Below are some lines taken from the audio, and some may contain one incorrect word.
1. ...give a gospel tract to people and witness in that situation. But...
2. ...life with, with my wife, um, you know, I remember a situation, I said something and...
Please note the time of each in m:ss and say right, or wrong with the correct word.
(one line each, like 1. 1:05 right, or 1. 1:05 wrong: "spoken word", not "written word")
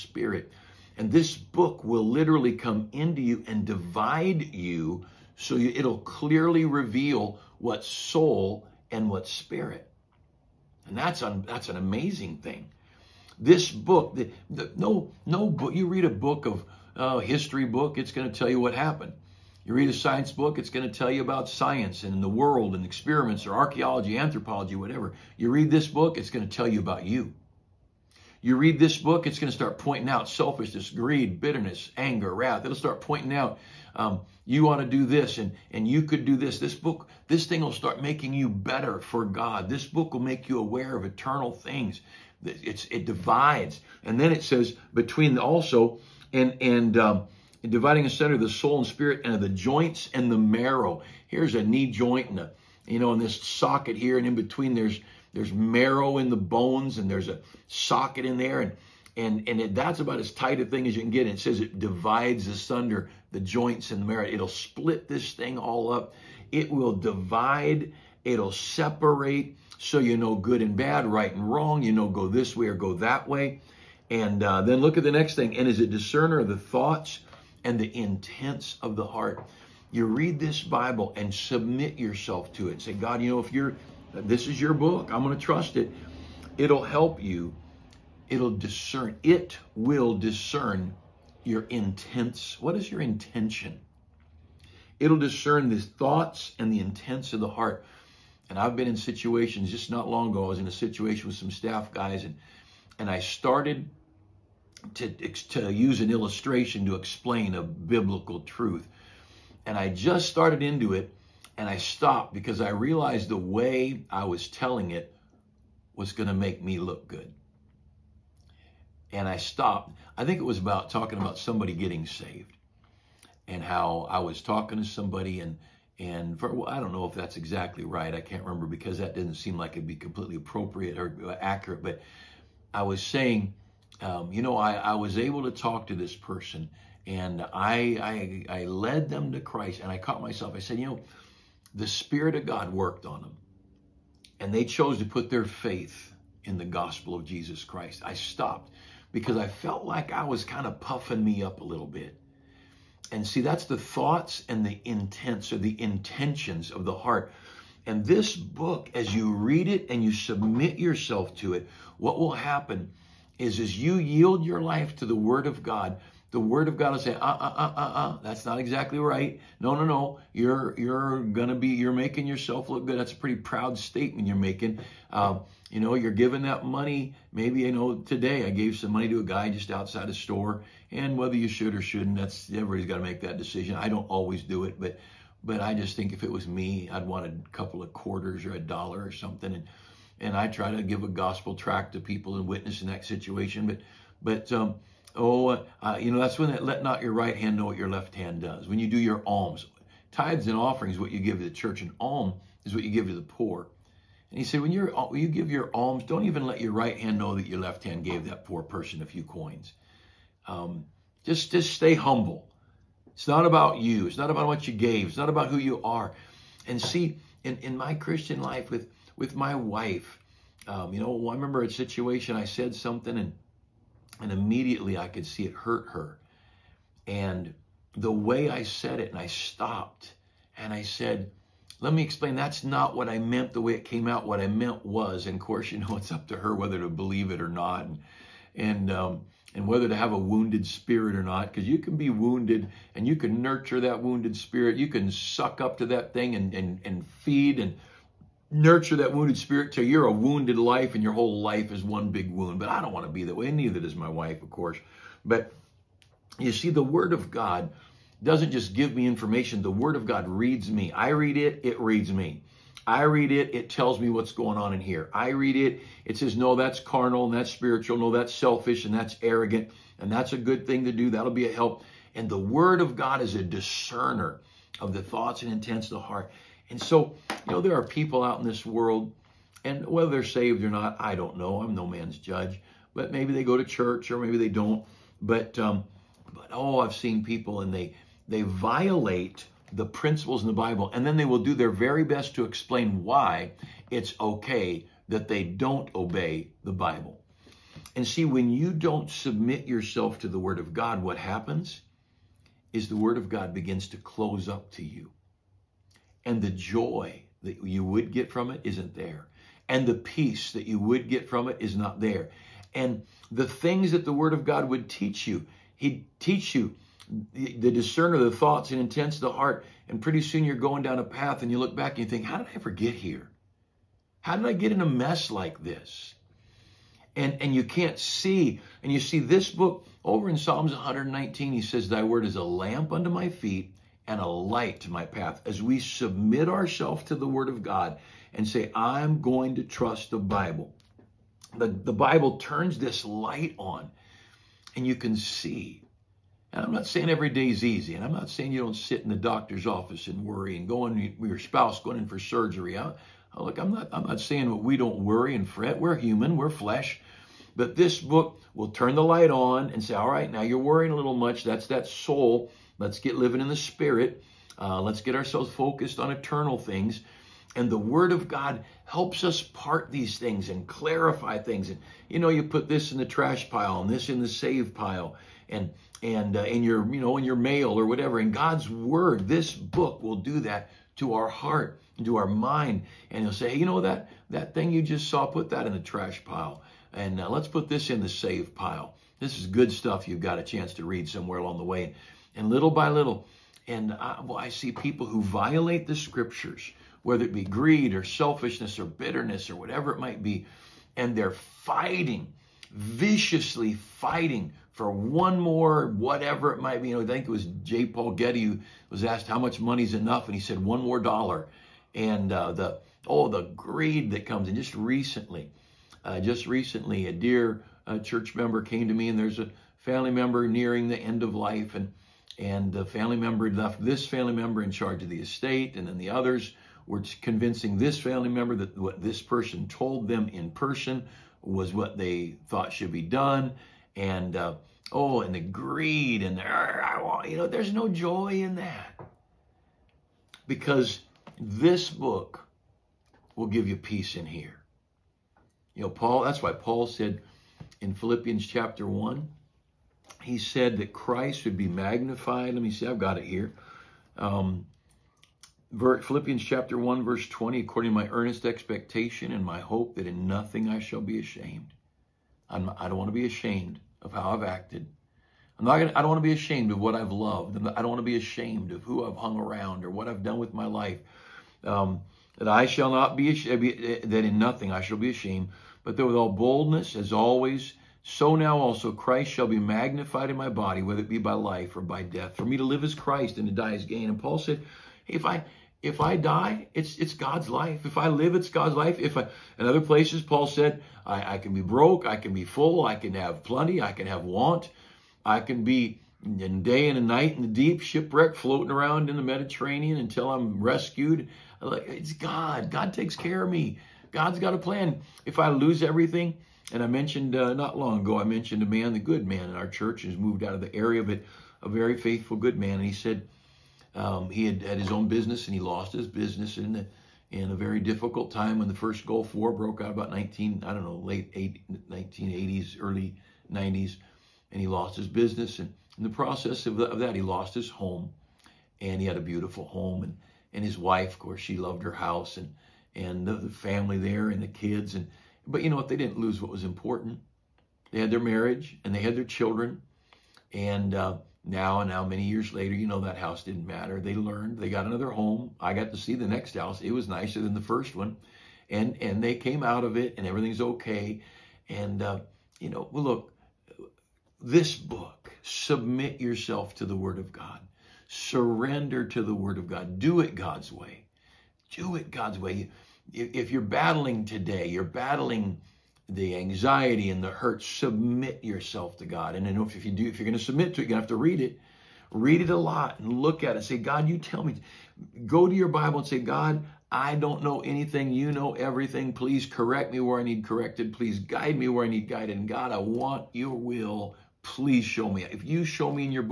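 1. 3:10 right
2. 3:38 right.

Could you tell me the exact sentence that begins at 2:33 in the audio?
And see, that's the thoughts and the intents or the intentions of the heart.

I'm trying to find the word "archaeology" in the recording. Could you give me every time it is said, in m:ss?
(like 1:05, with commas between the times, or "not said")
0:23.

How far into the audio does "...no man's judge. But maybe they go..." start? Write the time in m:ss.
4:41.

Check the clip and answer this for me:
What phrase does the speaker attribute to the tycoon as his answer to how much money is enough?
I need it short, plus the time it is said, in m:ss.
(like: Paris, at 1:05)
one more dollar, at 6:50.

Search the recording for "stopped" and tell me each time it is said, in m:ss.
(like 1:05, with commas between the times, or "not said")
1:51, 1:59, 2:28, 3:49.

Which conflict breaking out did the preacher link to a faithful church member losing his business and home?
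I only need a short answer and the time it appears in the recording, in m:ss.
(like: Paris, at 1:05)
first Gulf War, at 8:38.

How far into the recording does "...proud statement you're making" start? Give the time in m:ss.
2:53.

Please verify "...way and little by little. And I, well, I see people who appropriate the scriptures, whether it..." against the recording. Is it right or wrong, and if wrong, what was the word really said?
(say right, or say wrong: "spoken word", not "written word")
wrong: "violate", not "appropriate".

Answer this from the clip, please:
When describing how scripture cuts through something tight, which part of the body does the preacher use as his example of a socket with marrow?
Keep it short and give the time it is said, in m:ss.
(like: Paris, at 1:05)
knee joint, at 0:51.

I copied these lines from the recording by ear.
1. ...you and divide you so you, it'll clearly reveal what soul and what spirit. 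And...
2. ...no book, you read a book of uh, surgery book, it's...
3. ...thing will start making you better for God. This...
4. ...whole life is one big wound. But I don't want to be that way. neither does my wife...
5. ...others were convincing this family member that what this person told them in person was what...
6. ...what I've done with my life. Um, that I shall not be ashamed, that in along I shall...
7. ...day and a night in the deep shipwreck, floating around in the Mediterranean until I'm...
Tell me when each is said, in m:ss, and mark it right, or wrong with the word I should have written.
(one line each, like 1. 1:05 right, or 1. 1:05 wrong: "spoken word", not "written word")
1. 0:03 right
2. 0:15 wrong: "history", not "surgery"
3. 0:37 right
4. 4:11 right
5. 7:06 right
6. 7:49 wrong: "nothing", not "along"
7. 8:16 right.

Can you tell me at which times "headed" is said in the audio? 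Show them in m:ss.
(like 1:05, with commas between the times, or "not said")
not said.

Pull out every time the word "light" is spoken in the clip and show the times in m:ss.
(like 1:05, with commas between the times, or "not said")
5:34, 5:43, 5:59.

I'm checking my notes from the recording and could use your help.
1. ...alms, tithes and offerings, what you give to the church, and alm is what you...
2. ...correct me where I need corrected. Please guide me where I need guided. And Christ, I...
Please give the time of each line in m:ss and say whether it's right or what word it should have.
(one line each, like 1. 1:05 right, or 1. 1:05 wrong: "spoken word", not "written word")
1. 3:19 right
2. 9:39 wrong: "God", not "Christ".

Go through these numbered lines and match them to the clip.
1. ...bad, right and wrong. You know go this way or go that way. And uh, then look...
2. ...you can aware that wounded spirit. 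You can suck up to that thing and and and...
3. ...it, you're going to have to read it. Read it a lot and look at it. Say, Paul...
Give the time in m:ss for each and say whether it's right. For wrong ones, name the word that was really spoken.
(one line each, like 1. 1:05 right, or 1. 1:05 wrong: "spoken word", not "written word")
1. 1:10 right
2. 4:03 wrong: "nurture", not "aware"
3. 9:30 wrong: "God", not "Paul".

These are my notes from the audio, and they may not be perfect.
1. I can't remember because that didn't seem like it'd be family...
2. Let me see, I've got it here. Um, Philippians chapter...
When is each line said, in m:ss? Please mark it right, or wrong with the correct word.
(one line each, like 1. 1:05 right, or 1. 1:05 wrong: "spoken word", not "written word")
1. 2:08 wrong: "completely", not "family"
2. 7:32 right.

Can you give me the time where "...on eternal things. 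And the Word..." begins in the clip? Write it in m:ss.
6:05.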